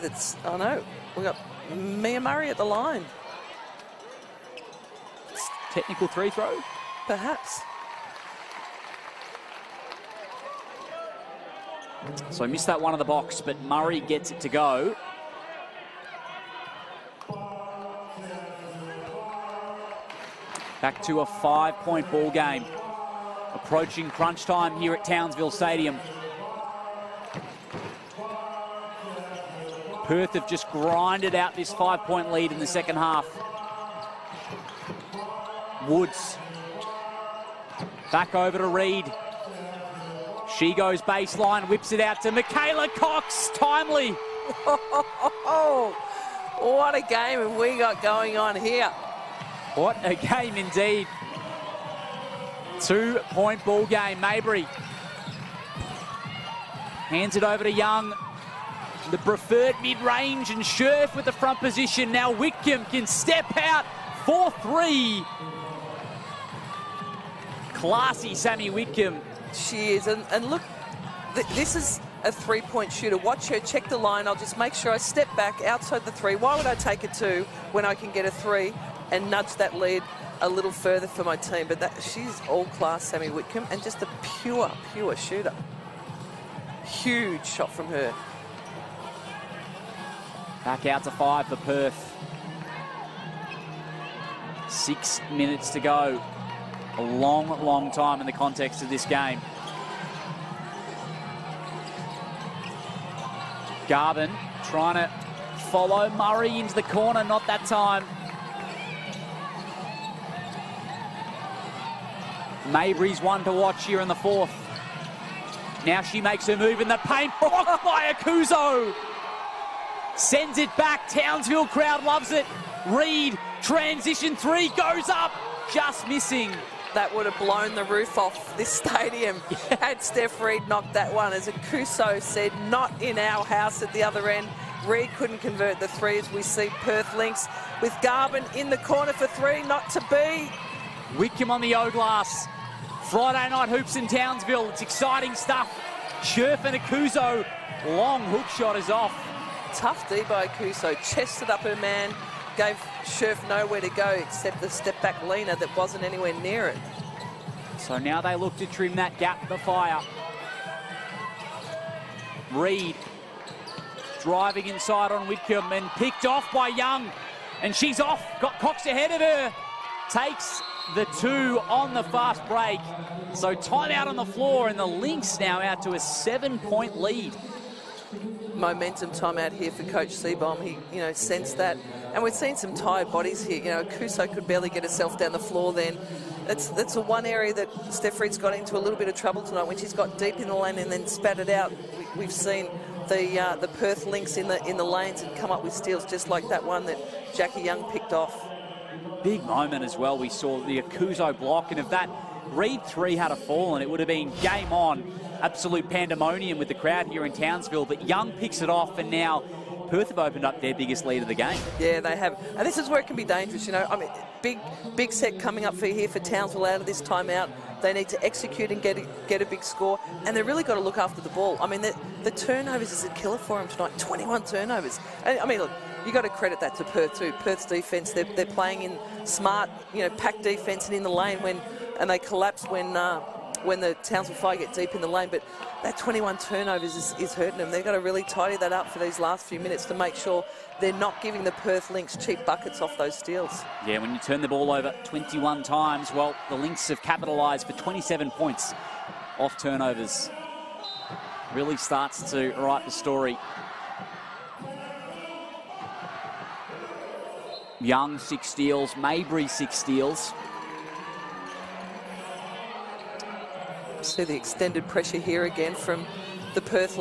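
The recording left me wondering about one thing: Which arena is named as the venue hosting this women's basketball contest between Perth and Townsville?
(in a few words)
Townsville Stadium.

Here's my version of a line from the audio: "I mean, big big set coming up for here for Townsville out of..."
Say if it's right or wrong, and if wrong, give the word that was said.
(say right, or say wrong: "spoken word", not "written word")
right.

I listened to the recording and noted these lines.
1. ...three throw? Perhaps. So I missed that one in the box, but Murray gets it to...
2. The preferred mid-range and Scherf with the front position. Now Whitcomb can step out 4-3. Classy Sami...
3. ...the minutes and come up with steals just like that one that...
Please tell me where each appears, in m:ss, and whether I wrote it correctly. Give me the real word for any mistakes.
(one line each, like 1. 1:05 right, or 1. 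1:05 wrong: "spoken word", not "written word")
1. 0:06 right
2. 0:59 right
3. 3:14 wrong: "lanes", not "minutes".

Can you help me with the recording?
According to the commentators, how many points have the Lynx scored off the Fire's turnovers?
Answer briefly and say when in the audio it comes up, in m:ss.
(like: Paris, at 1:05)
27, at 4:07.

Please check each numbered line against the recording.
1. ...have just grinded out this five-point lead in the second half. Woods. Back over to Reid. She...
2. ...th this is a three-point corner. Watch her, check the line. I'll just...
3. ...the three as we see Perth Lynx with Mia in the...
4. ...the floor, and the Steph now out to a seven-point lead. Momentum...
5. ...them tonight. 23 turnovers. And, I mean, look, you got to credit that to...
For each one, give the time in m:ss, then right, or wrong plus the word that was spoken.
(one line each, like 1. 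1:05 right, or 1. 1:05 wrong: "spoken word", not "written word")
1. 0:30 right
2. 1:11 wrong: "shooter", not "corner"
3. 2:15 wrong: "Garbin", not "Mia"
4. 2:54 wrong: "Lynx", not "Steph"
5. 3:43 wrong: "21", not "23".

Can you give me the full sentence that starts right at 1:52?
Mabrey's one to watch here in the fourth.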